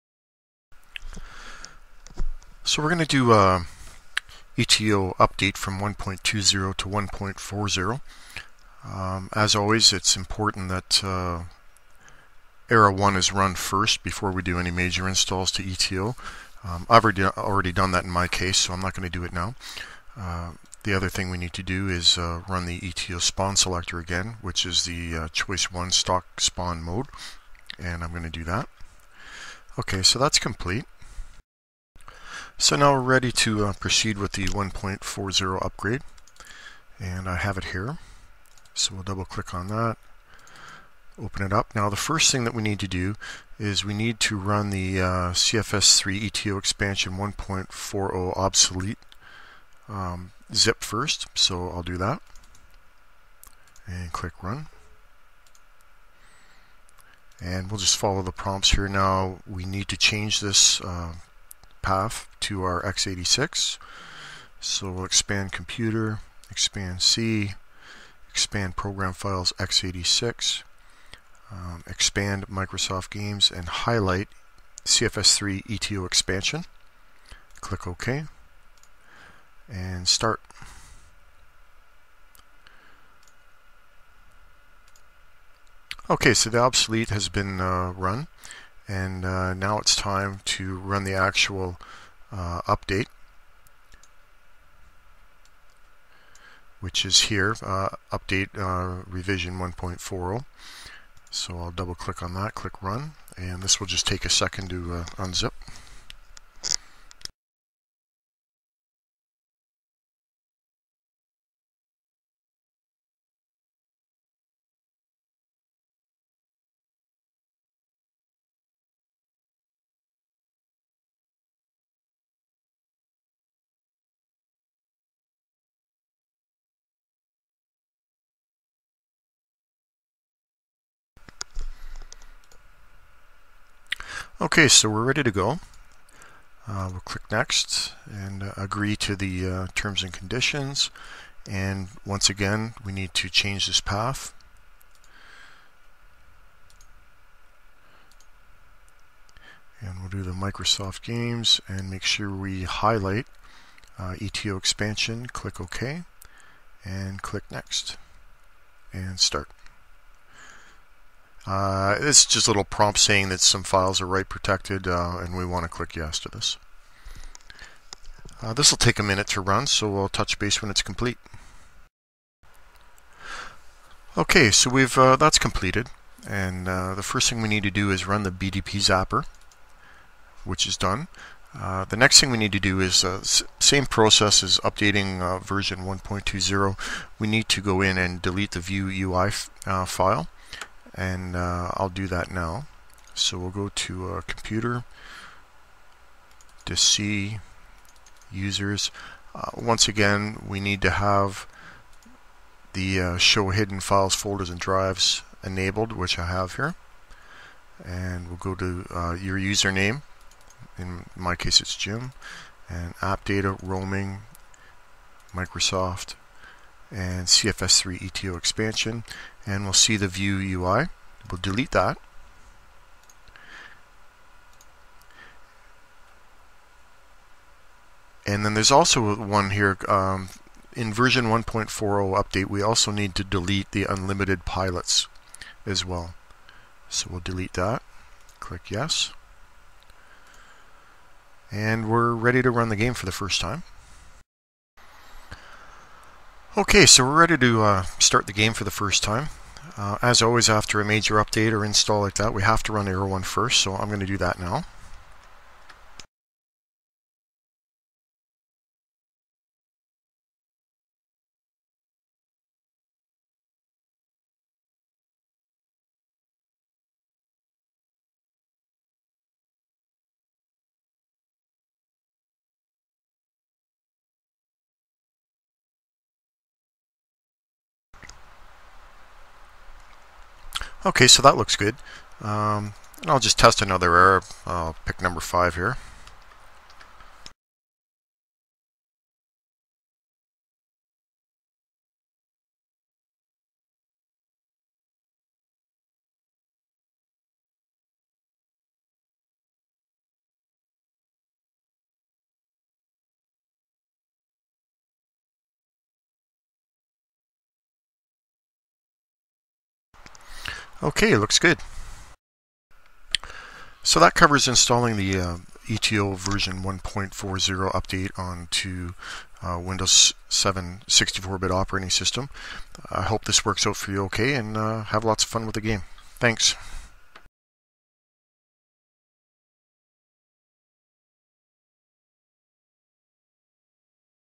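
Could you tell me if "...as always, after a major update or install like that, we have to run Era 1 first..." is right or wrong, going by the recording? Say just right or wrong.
right.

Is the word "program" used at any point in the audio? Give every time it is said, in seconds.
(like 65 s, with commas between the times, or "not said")
68 s.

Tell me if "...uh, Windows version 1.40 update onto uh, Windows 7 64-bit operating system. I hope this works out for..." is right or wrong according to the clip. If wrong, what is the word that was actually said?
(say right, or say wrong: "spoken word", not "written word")
wrong: "ETO", not "Windows".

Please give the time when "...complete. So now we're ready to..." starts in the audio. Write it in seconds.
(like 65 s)
30 s.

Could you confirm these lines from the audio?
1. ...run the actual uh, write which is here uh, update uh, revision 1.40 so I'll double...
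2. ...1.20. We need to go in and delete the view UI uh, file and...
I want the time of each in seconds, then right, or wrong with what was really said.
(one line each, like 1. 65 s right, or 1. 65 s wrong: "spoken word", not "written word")
1. 90 s wrong: "update", not "write"
2. 185 s right.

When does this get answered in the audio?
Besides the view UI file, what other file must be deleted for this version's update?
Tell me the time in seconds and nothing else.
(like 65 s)
233 s.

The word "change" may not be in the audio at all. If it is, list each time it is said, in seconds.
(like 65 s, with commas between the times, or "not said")
59 s, 143 s.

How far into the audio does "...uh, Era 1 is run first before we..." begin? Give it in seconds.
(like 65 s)
11 s.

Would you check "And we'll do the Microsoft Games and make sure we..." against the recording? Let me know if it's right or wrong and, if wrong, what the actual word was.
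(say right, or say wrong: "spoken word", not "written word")
right.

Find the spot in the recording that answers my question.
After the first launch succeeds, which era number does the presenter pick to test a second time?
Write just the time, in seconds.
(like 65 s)
285 s.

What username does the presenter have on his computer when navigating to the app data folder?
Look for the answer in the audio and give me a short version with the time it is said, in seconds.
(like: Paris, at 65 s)
Jim, at 211 s.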